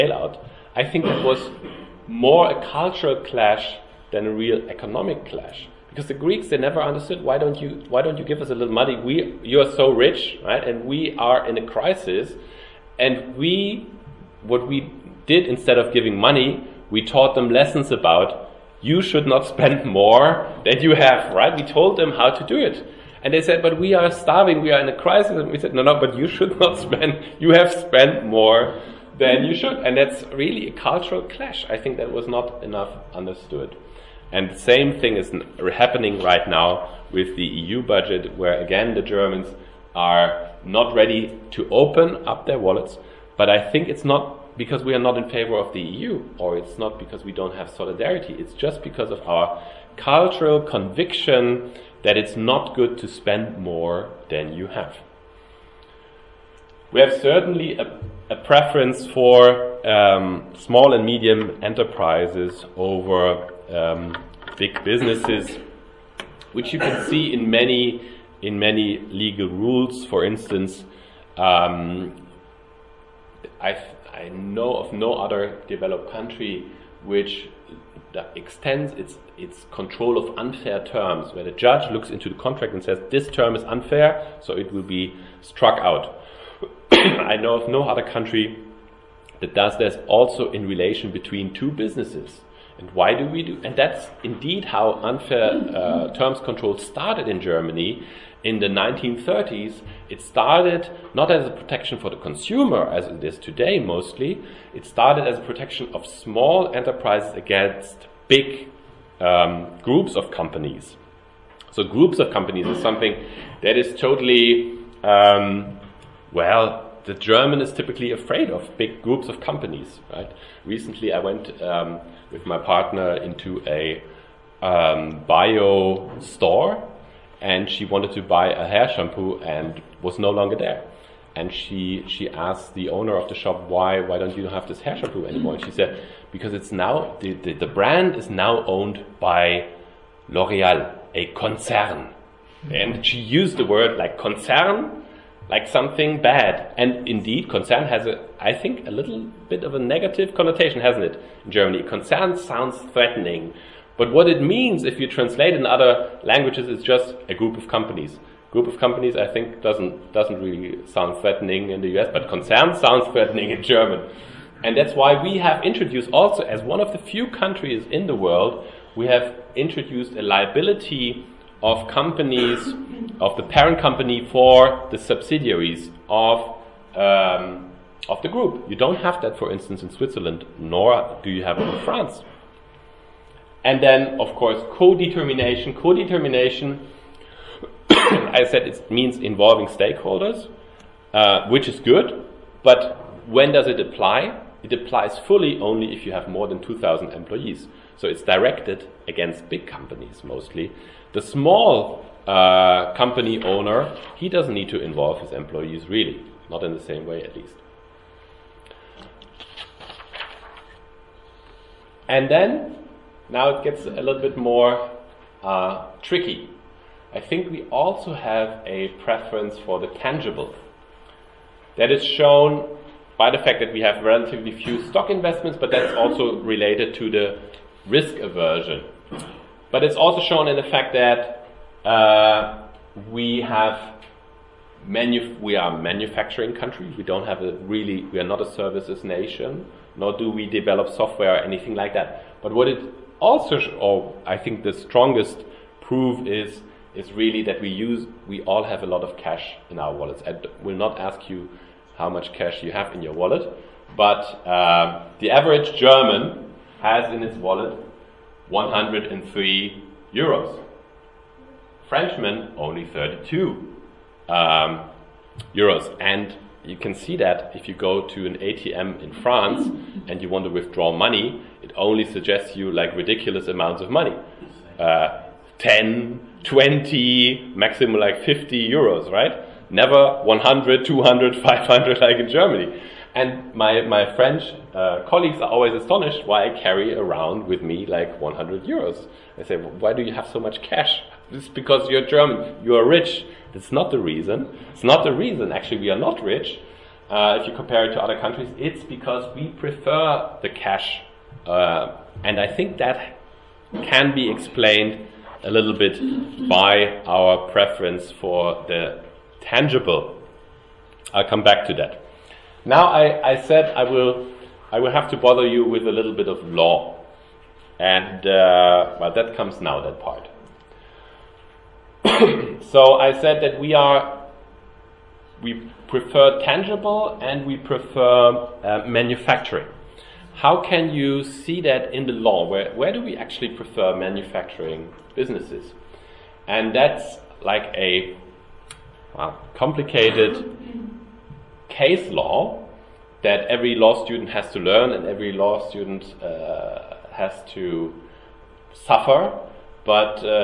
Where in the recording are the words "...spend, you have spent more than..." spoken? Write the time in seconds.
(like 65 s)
26 s.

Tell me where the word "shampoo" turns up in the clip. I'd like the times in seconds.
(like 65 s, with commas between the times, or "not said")
128 s, 134 s.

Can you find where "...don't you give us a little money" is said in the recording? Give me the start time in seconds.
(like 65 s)
8 s.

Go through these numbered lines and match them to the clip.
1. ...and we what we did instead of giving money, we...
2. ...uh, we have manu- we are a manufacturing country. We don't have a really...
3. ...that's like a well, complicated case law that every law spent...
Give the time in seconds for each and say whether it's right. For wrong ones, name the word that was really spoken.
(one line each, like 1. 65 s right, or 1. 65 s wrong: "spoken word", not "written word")
1. 12 s right
2. 231 s right
3. 336 s wrong: "student", not "spent".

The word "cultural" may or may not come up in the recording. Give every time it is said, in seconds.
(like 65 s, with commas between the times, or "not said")
2 s, 30 s, 49 s.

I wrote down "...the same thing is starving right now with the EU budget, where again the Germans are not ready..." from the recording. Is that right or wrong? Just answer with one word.
wrong.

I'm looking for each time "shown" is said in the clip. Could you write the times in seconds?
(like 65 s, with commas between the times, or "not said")
222 s, 230 s.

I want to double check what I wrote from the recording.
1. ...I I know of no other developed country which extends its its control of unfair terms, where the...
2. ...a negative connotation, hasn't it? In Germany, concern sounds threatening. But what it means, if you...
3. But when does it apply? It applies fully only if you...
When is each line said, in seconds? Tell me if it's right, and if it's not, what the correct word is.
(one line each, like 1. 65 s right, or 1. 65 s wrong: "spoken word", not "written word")
1. 73 s right
2. 149 s right
3. 192 s right.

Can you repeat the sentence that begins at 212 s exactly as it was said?
And then, now it gets a little bit more uh, tricky.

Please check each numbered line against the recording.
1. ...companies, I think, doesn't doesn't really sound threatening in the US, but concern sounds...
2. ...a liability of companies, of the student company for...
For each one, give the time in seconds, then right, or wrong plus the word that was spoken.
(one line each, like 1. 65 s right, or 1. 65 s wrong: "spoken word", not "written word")
1. 158 s right
2. 170 s wrong: "parent", not "student".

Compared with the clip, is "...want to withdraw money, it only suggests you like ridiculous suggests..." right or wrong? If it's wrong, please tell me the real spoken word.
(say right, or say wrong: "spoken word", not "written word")
wrong: "amounts", not "suggests".